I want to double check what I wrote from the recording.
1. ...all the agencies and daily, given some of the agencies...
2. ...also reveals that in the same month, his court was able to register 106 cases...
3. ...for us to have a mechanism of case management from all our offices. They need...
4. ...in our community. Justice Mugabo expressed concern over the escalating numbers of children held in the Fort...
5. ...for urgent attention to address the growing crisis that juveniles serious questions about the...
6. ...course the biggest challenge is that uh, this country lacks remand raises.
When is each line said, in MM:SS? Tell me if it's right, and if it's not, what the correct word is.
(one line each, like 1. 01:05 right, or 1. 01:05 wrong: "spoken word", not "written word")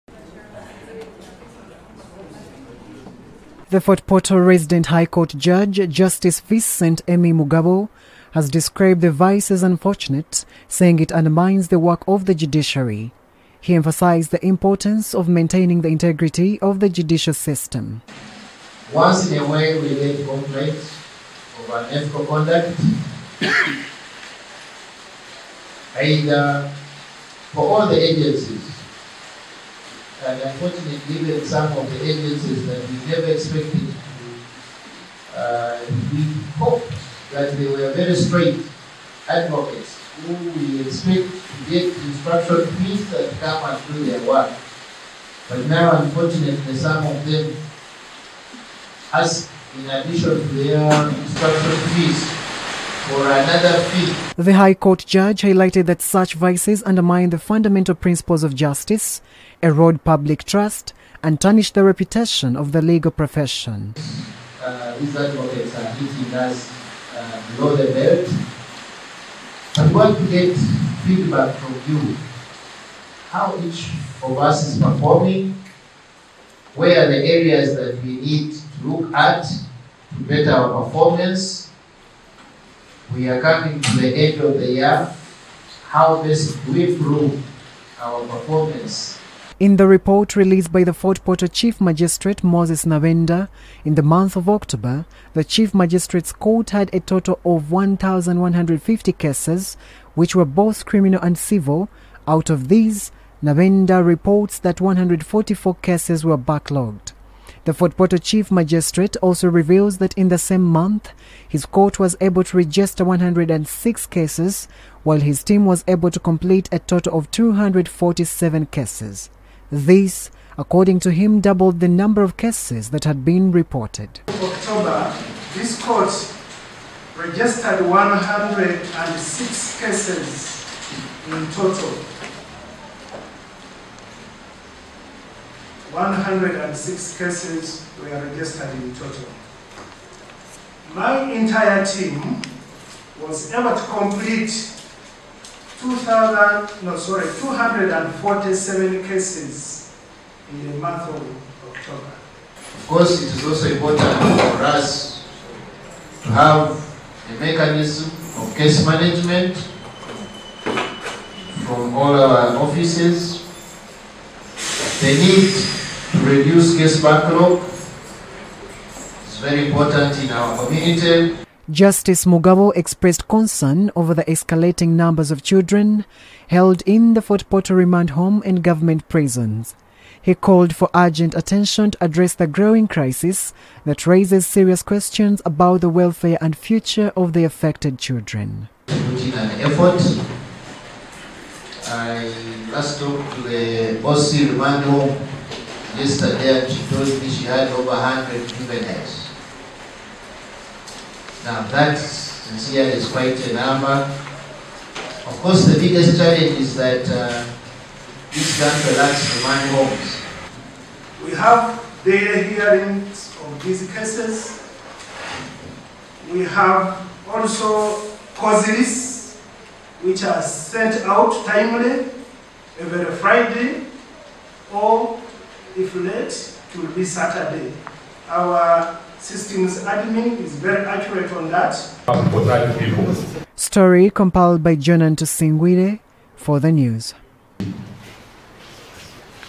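1. 00:27 wrong: "unfortunately", not "daily"
2. 01:49 right
3. 02:34 right
4. 02:50 right
5. 03:00 wrong: "raises", not "juveniles"
6. 03:25 wrong: "homes", not "raises".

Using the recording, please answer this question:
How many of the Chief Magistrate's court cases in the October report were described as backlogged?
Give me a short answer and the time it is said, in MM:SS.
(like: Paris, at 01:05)
144, at 01:44.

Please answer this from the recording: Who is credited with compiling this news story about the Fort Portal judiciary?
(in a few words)
Jonan Tosingwire.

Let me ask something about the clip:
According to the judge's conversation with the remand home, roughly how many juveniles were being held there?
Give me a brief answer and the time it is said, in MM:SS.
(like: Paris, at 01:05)
over 100, at 03:17.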